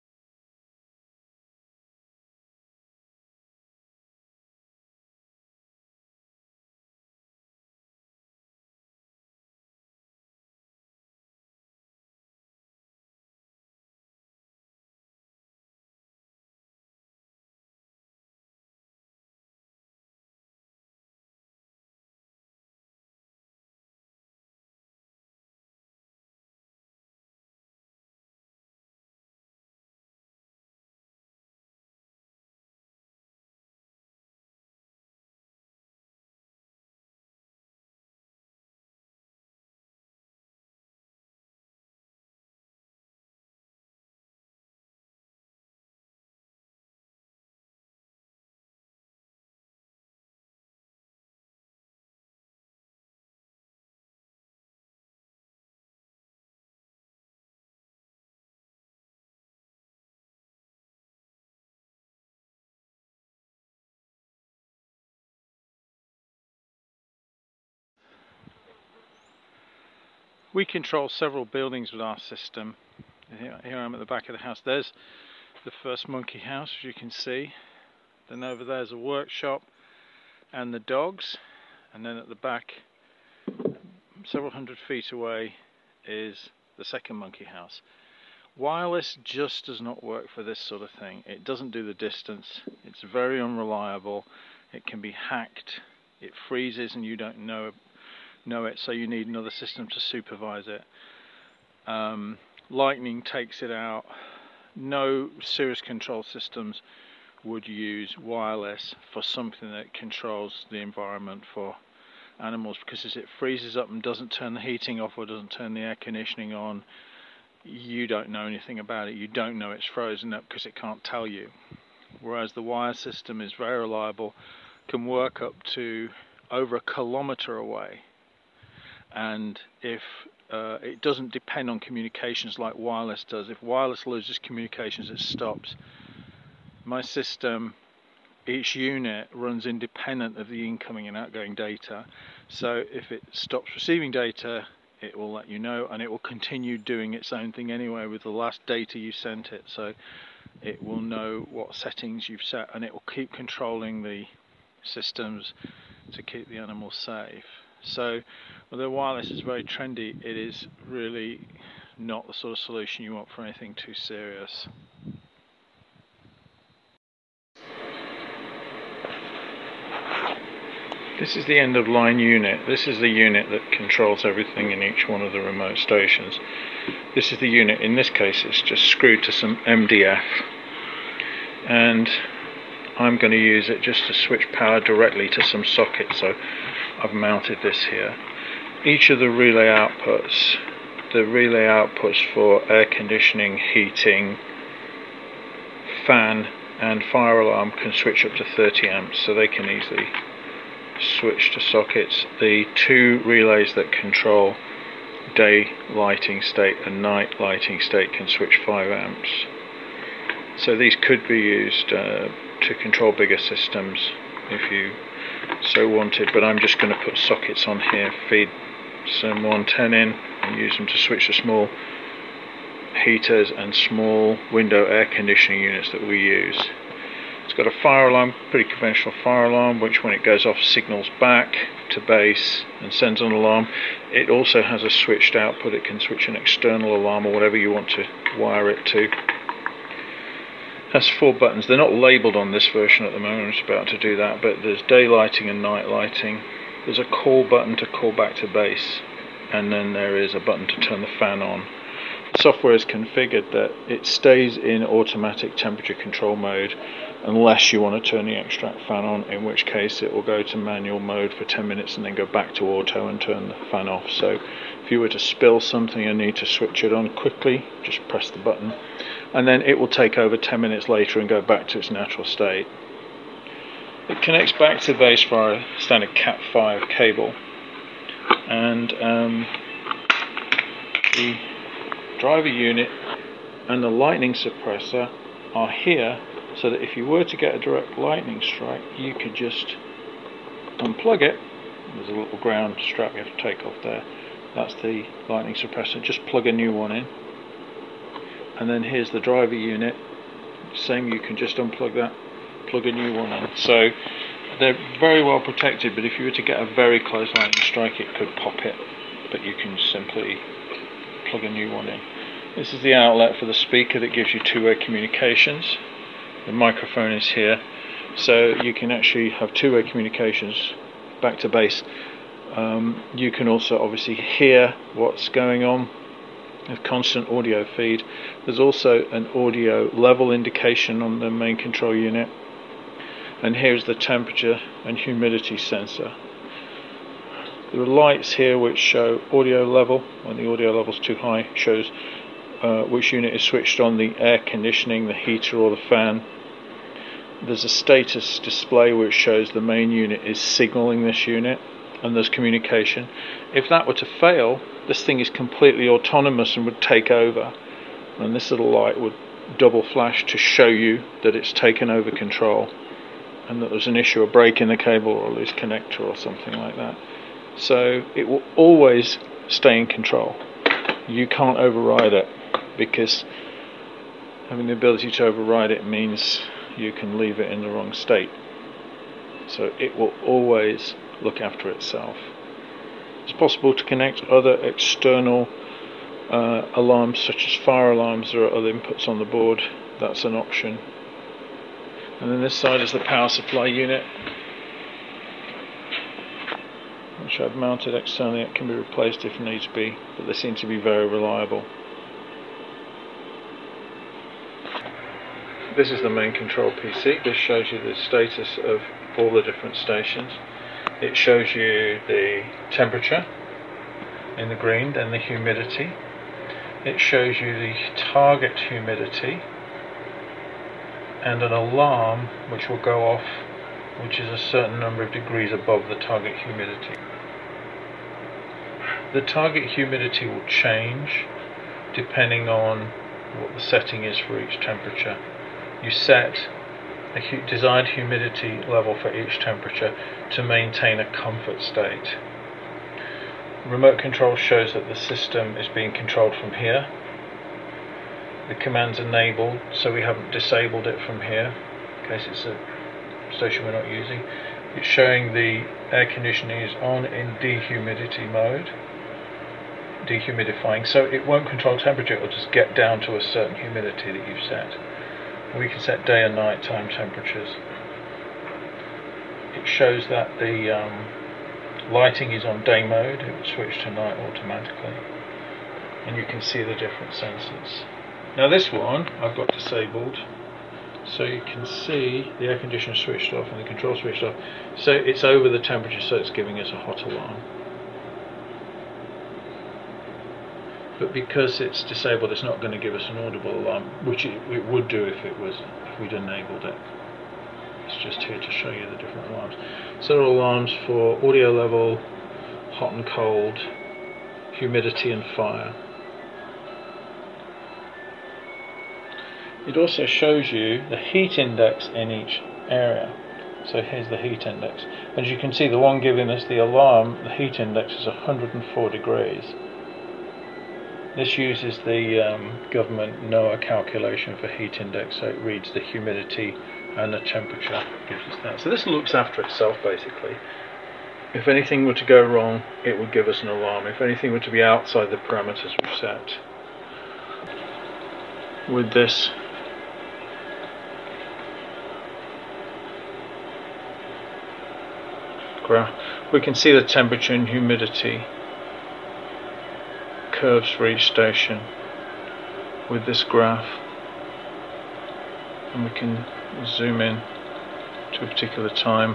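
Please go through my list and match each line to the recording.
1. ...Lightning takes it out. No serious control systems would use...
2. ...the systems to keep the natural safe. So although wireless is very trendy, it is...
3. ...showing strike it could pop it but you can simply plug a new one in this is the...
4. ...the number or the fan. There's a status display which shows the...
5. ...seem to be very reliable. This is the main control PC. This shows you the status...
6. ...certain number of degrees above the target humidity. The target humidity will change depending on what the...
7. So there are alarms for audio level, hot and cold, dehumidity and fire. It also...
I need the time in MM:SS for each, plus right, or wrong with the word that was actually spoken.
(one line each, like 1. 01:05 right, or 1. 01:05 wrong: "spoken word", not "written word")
1. 01:42 right
2. 02:34 wrong: "animal", not "natural"
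3. 05:07 wrong: "lightning", not "showing"
4. 05:45 wrong: "heater", not "number"
5. 06:40 right
6. 07:04 right
7. 08:19 wrong: "humidity", not "dehumidity".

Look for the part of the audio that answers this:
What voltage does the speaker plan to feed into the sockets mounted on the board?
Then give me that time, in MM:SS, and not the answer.
03:39.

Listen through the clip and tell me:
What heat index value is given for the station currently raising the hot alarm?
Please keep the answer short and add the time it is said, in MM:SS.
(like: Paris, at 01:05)
104 degrees, at 08:38.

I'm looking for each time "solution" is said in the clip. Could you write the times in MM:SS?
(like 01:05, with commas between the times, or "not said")
02:42.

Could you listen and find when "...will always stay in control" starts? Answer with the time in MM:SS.
06:08.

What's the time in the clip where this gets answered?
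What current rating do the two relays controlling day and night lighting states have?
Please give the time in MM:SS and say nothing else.
03:28.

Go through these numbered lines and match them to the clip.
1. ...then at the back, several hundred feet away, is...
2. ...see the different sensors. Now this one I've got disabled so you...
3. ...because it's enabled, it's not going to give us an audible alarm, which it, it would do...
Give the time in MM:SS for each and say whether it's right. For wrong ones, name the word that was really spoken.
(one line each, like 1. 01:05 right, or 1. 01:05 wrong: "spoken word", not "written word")
1. 01:22 right
2. 07:56 right
3. 08:11 wrong: "disabled", not "enabled".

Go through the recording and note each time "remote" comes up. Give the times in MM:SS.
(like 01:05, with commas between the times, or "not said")
02:55, 07:23.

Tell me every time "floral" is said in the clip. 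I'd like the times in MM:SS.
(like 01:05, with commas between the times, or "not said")
not said.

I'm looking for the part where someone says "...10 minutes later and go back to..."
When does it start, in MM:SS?
04:30.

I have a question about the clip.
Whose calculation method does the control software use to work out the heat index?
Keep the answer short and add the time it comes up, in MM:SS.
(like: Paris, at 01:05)
NOAA, at 08:43.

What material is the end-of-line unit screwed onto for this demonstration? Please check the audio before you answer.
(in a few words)
MDF.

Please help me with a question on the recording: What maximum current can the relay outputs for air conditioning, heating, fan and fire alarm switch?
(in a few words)
30 amps.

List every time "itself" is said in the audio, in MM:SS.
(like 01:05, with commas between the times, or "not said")
06:21, 08:49.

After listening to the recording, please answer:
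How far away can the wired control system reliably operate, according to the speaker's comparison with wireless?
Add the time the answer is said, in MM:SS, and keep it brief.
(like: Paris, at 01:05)
over a kilometer, at 02:06.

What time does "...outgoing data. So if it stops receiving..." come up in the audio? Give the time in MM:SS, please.
02:21.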